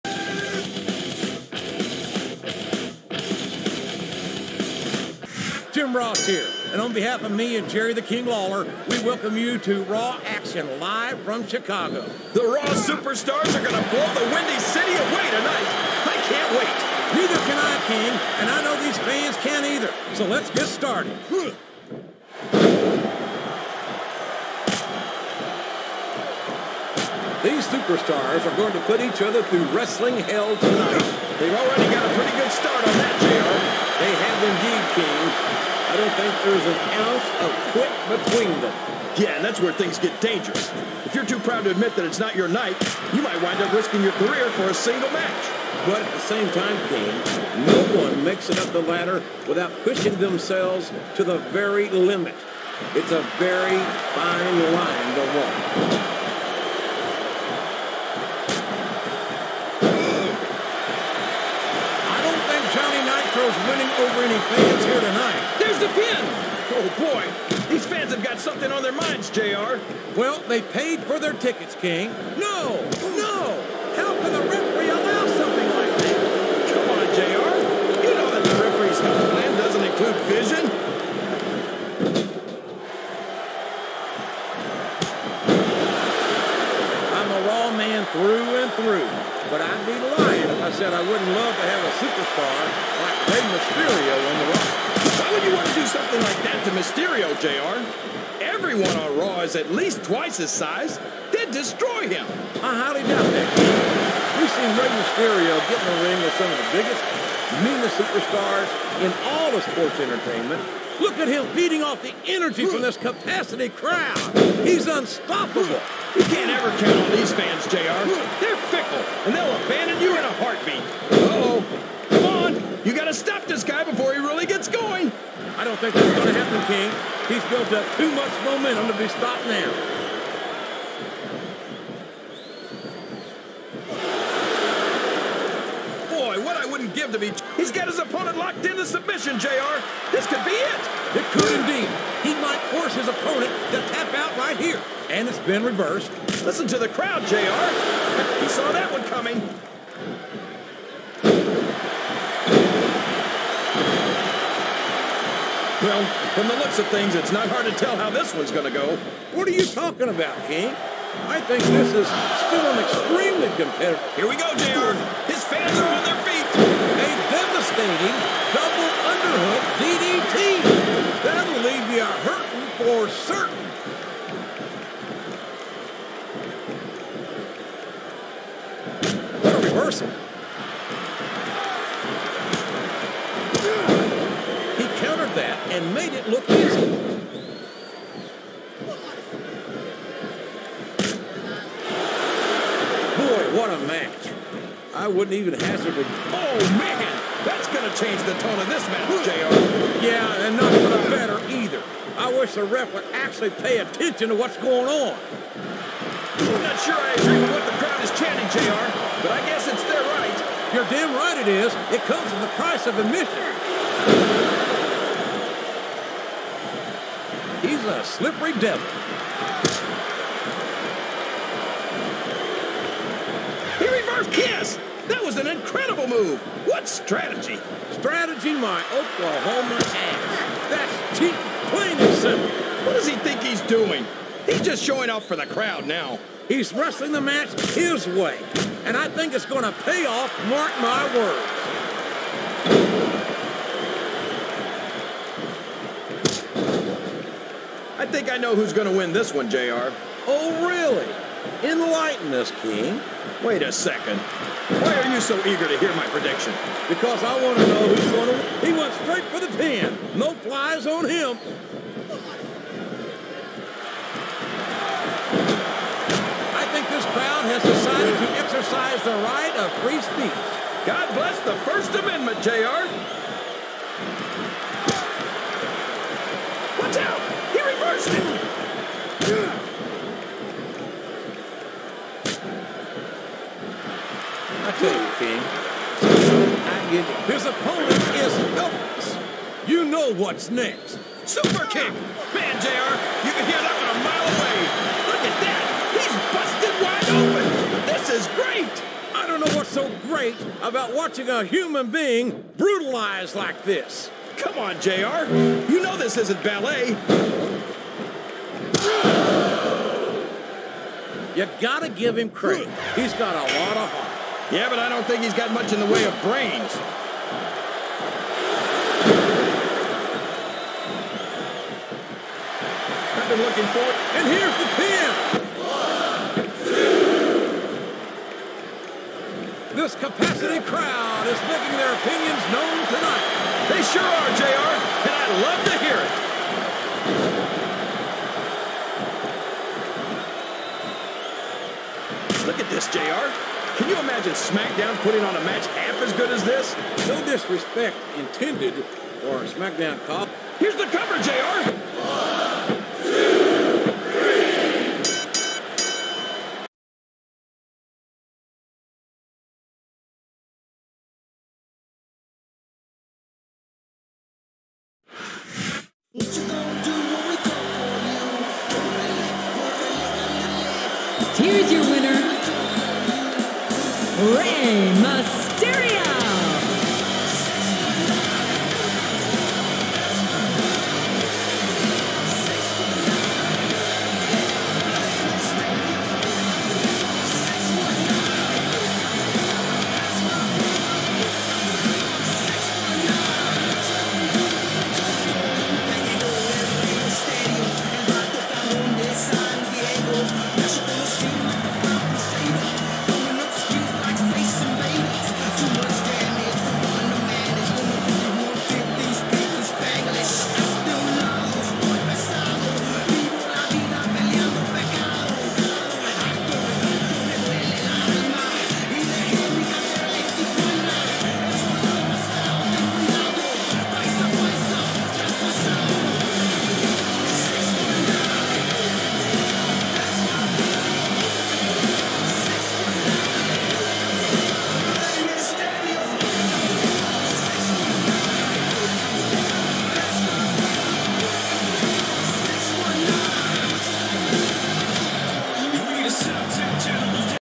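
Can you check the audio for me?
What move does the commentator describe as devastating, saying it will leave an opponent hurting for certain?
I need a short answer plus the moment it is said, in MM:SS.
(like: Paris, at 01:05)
double underhook DDT, at 02:48.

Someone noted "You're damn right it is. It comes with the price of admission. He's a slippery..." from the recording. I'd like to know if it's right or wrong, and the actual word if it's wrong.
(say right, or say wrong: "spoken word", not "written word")
right.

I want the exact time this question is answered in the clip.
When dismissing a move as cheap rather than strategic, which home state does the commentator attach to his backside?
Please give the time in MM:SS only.
03:48.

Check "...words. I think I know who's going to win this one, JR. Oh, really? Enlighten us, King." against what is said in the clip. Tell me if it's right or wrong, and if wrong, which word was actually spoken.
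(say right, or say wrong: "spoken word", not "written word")
right.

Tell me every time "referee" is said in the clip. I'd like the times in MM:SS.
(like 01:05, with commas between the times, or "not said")
01:14, 01:18.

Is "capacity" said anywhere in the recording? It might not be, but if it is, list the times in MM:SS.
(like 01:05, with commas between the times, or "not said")
01:52, 05:29.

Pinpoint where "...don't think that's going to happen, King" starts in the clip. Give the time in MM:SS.
02:05.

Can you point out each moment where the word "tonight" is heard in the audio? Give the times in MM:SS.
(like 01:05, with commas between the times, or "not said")
00:15, 00:30, 01:04, 05:32.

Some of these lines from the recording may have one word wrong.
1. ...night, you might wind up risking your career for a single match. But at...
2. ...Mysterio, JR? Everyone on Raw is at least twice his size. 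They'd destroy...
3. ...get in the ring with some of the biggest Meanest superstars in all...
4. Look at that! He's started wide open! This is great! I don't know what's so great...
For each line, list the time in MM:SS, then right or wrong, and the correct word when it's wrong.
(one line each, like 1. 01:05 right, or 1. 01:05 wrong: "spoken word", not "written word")
1. 00:42 right
2. 01:36 right
3. 01:45 right
4. 04:57 wrong: "busted", not "started".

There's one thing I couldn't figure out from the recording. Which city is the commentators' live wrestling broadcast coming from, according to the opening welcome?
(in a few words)
Chicago.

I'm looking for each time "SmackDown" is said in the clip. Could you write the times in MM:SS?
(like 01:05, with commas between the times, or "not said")
05:44, 05:49.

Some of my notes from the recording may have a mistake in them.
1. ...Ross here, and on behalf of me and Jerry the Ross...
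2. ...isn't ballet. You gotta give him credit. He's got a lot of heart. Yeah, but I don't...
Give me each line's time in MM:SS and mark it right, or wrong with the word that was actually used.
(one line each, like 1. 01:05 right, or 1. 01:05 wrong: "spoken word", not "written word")
1. 00:05 wrong: "King", not "Ross"
2. 05:06 right.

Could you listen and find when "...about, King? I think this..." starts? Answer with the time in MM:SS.
02:40.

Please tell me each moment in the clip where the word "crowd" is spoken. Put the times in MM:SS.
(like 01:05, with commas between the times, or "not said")
01:53, 02:26, 03:27, 03:55, 04:27, 05:30.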